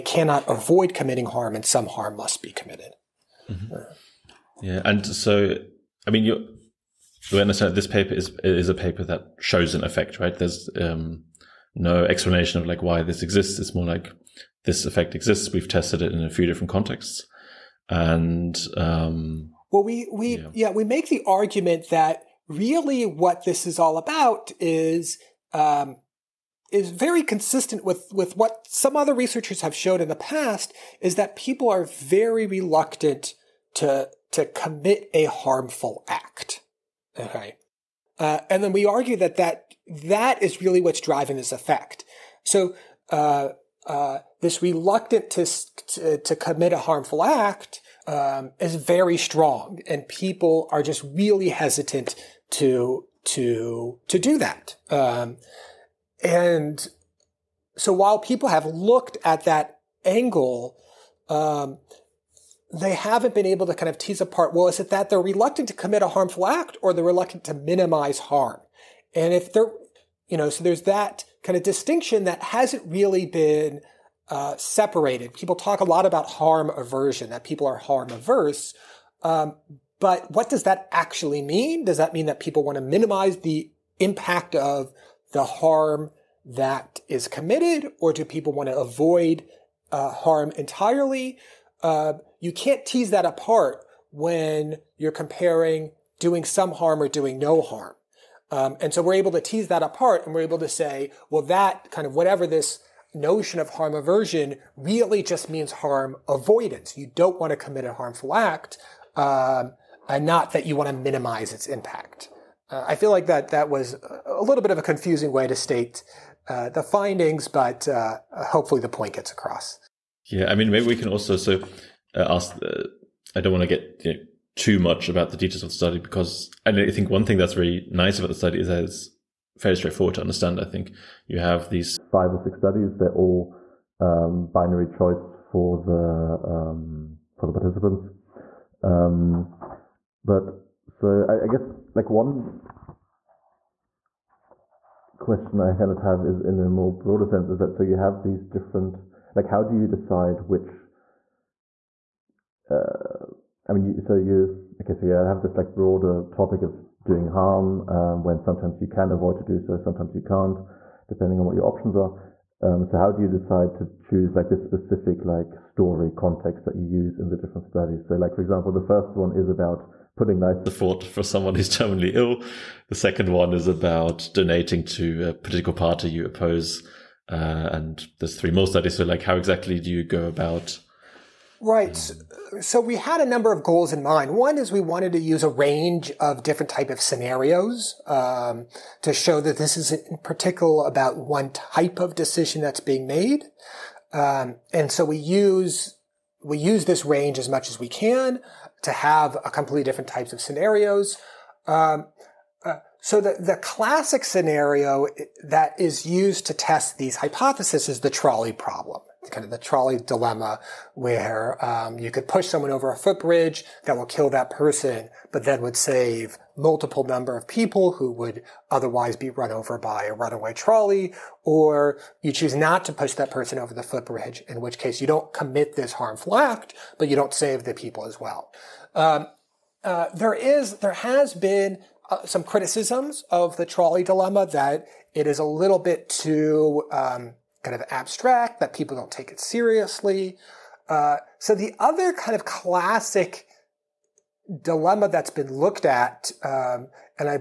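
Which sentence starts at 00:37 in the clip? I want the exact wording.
Okay, uh, and then we argue that that that is really what's driving this effect.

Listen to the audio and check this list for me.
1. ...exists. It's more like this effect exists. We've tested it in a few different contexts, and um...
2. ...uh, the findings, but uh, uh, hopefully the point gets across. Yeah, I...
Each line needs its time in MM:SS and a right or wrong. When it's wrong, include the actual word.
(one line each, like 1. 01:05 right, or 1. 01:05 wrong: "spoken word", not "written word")
1. 00:13 right
2. 01:56 right.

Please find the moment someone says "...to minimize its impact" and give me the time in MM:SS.
01:50.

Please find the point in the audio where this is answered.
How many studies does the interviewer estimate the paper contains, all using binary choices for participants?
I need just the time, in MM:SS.
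02:12.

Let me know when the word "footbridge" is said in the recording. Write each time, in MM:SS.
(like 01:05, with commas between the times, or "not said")
03:32, 03:43.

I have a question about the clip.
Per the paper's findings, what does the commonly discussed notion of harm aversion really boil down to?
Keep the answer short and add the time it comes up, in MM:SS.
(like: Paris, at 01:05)
harm avoidance, at 01:45.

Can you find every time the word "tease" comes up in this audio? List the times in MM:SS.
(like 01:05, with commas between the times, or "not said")
01:03, 01:32, 01:39.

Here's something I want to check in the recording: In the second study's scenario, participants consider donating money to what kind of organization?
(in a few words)
a political party you oppose.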